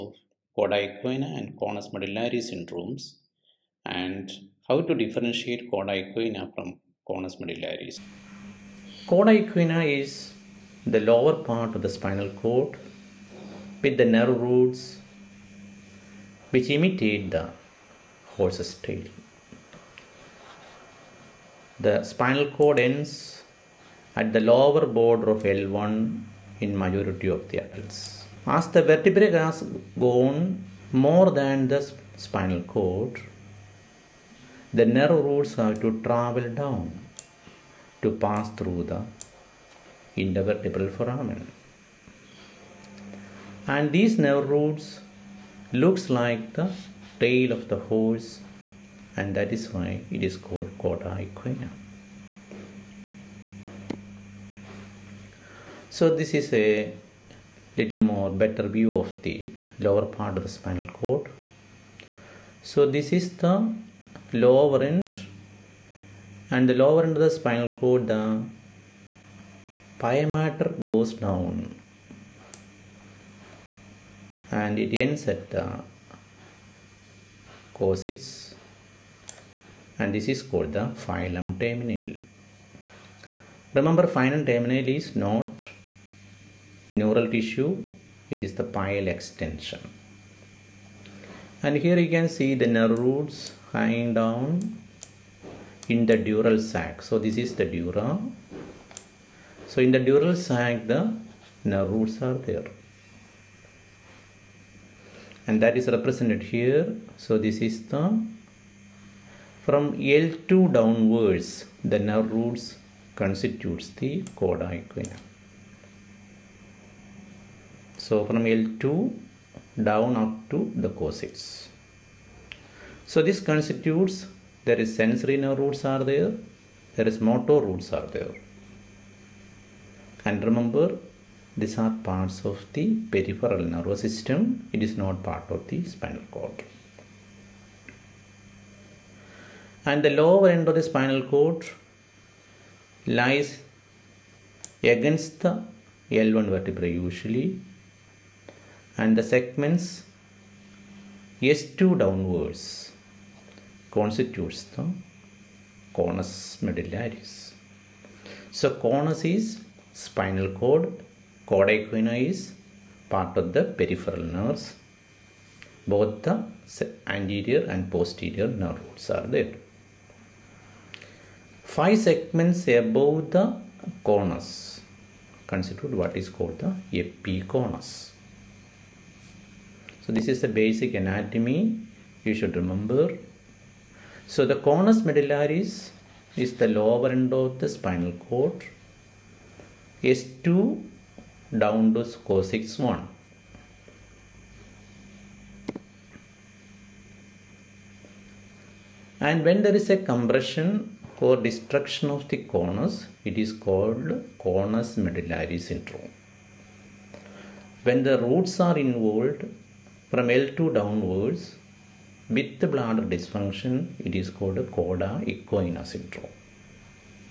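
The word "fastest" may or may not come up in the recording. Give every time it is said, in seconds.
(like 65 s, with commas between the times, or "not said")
not said.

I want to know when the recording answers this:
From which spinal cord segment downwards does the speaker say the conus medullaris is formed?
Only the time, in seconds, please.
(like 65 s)
151 s.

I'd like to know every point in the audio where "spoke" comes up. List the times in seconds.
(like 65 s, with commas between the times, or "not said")
not said.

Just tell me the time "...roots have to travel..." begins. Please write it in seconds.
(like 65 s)
35 s.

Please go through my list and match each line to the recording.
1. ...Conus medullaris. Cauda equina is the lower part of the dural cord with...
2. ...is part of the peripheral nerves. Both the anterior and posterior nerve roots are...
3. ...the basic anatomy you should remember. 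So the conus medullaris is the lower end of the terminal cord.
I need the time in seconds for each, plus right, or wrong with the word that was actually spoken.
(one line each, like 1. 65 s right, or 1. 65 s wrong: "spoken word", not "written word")
1. 7 s wrong: "spinal", not "dural"
2. 162 s right
3. 180 s wrong: "spinal", not "terminal".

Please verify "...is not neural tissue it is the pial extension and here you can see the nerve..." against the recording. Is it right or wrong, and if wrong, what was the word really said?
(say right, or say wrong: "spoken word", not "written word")
right.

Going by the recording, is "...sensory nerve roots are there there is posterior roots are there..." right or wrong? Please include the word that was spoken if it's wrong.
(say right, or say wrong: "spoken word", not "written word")
wrong: "motor", not "posterior".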